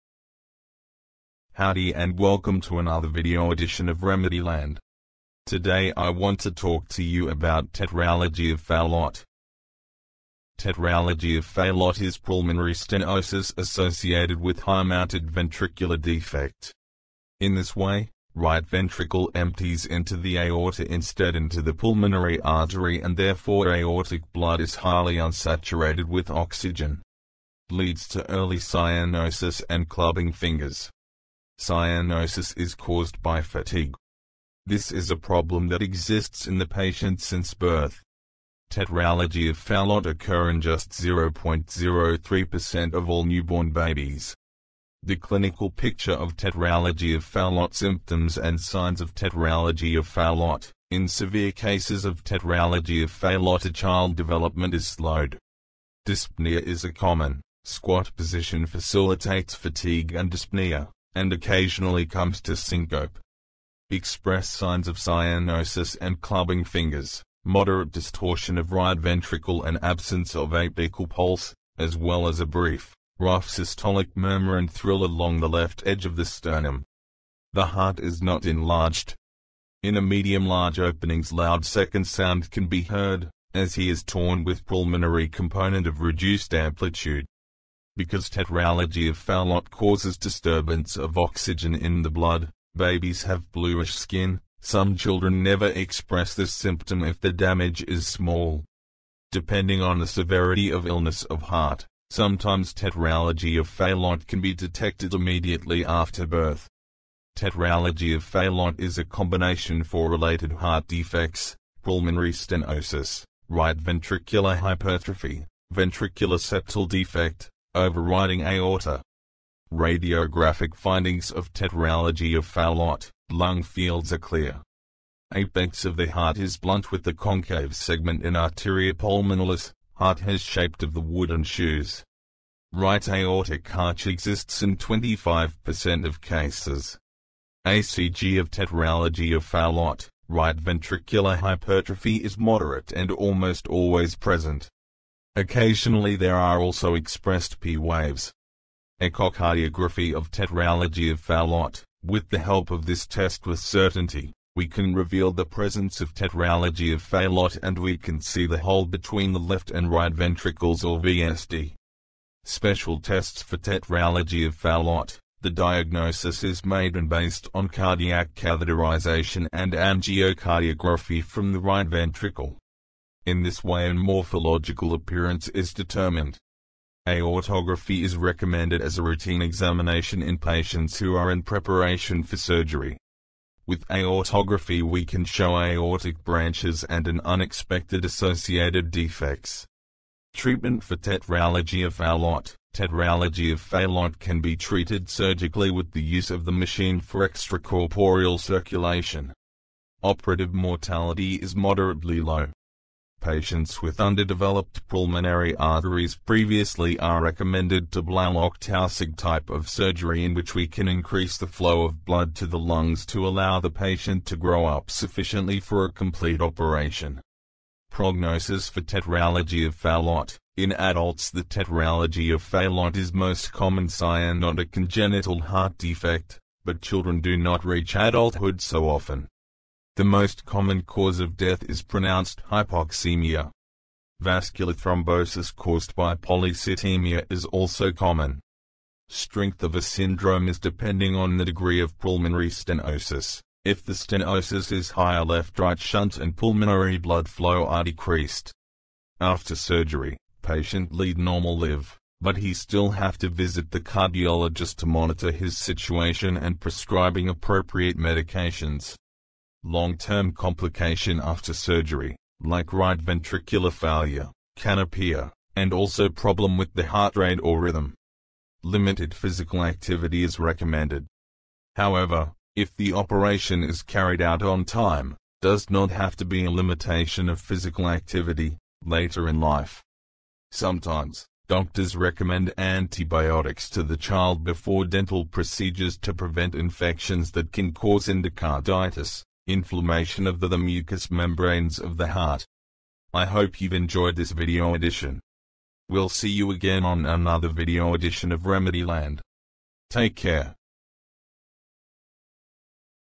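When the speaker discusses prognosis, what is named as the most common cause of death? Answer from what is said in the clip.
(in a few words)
pronounced hypoxemia.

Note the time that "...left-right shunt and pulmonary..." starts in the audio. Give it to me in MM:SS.
04:05.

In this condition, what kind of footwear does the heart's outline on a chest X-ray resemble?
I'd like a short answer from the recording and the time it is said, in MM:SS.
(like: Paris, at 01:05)
wooden shoes, at 02:10.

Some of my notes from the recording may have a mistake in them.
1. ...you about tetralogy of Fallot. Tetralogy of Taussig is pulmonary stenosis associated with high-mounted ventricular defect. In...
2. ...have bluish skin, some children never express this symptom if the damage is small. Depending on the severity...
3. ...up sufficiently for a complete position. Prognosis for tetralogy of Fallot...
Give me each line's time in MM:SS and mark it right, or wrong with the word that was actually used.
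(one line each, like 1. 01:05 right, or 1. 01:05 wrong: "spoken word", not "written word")
1. 00:07 wrong: "Fallot", not "Taussig"
2. 01:33 right
3. 03:34 wrong: "operation", not "position".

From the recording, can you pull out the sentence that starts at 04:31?
However, if the operation is carried out on time, does not have to be a limitation of physical activity, later in life.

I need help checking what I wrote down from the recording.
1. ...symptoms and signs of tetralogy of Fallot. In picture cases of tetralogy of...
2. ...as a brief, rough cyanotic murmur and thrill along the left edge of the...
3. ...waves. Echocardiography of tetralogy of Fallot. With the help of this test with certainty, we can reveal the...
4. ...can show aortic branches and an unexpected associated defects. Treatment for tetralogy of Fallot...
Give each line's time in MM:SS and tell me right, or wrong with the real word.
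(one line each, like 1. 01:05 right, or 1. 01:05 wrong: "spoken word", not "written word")
1. 00:47 wrong: "severe", not "picture"
2. 01:12 wrong: "systolic", not "cyanotic"
3. 02:27 right
4. 03:05 right.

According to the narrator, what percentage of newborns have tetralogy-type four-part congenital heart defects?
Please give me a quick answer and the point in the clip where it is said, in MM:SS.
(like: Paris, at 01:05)
0.03%, at 00:40.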